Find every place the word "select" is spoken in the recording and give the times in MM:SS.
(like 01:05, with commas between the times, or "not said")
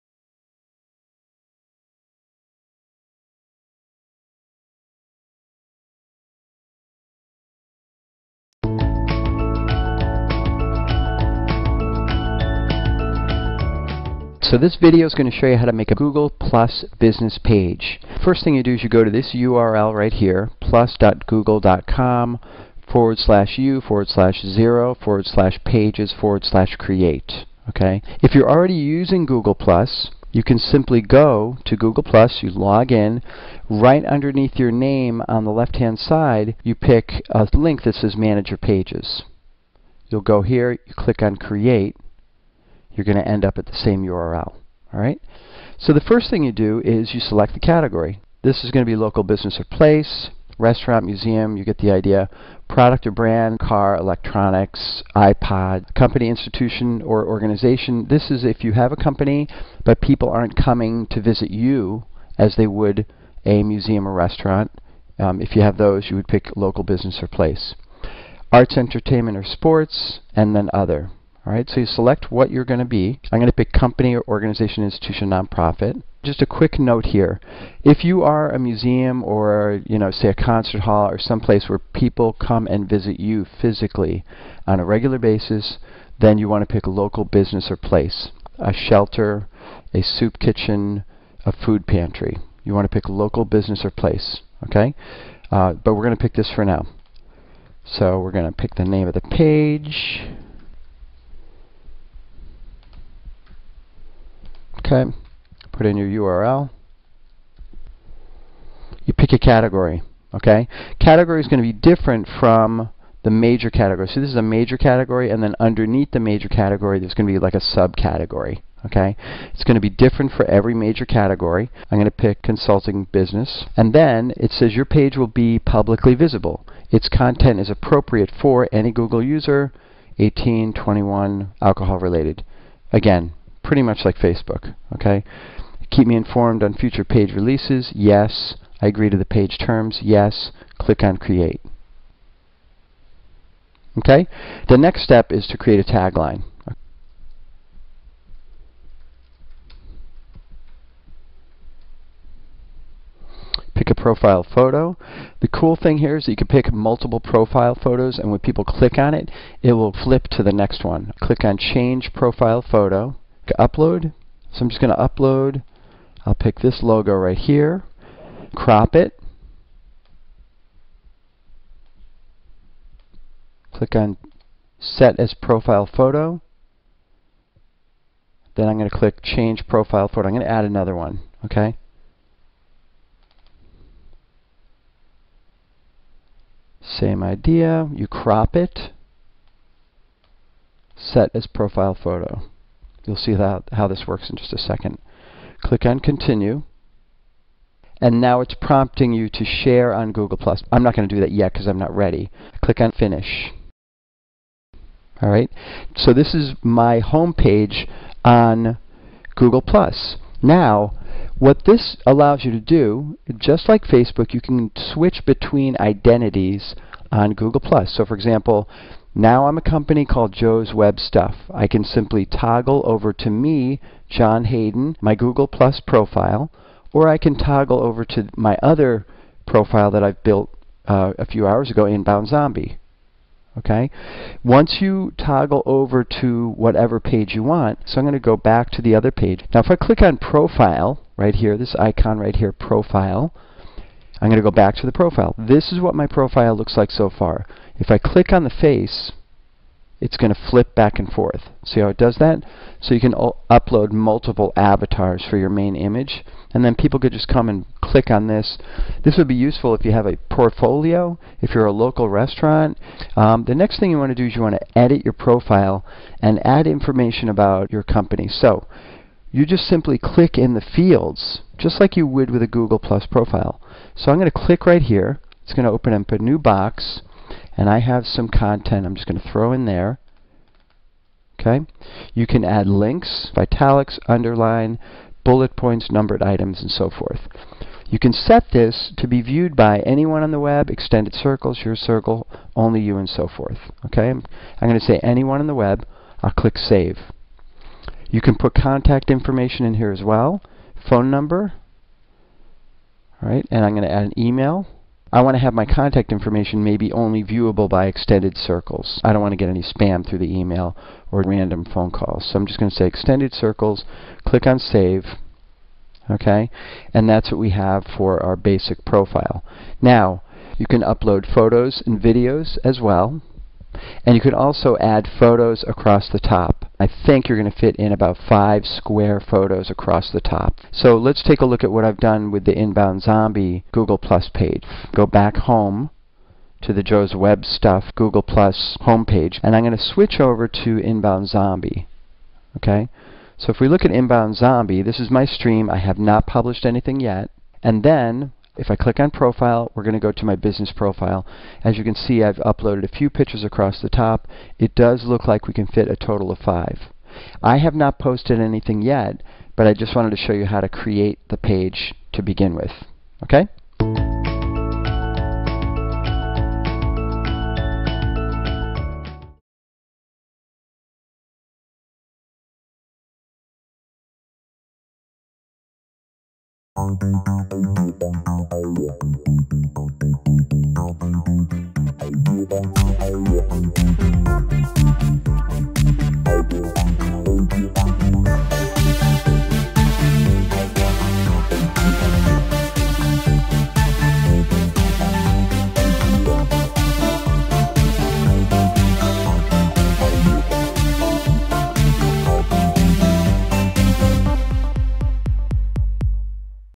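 00:47, 01:11.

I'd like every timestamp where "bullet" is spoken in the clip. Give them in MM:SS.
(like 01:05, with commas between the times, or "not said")
04:45.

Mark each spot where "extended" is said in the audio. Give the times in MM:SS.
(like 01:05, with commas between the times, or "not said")
04:50, 05:07, 05:12.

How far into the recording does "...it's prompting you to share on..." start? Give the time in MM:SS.
03:18.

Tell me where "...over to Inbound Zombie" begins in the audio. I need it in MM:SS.
05:40.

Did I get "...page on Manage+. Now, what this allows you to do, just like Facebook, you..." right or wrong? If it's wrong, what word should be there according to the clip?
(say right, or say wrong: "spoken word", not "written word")
wrong: "Google", not "Manage".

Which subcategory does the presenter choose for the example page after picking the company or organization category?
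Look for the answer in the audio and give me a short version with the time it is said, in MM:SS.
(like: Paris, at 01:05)
consulting business, at 02:02.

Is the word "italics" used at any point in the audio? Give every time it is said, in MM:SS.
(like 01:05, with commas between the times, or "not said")
04:43.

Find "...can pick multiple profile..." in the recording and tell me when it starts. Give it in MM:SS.
02:36.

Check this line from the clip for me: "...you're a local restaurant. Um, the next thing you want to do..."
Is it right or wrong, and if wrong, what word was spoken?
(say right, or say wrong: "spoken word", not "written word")
right.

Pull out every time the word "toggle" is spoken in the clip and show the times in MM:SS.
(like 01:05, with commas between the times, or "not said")
03:42, 03:47, 03:55.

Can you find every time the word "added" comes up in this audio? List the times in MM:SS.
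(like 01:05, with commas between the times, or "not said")
not said.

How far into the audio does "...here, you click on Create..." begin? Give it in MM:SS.
00:40.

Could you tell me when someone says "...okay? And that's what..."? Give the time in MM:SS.
05:16.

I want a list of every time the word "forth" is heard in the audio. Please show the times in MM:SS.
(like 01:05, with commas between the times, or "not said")
04:11, 04:46, 04:53.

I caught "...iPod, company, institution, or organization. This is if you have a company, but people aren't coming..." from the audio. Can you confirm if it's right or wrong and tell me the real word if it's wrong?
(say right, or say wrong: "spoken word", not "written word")
right.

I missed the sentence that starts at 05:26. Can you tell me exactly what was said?
I think you're going to fit in about five square photos across the top.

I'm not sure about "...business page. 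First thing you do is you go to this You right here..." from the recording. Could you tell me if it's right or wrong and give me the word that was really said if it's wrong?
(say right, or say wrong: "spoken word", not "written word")
wrong: "URL", not "You".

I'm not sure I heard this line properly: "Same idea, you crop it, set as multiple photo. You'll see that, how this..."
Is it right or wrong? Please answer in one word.
wrong.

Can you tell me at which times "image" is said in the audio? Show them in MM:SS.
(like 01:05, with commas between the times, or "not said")
04:15.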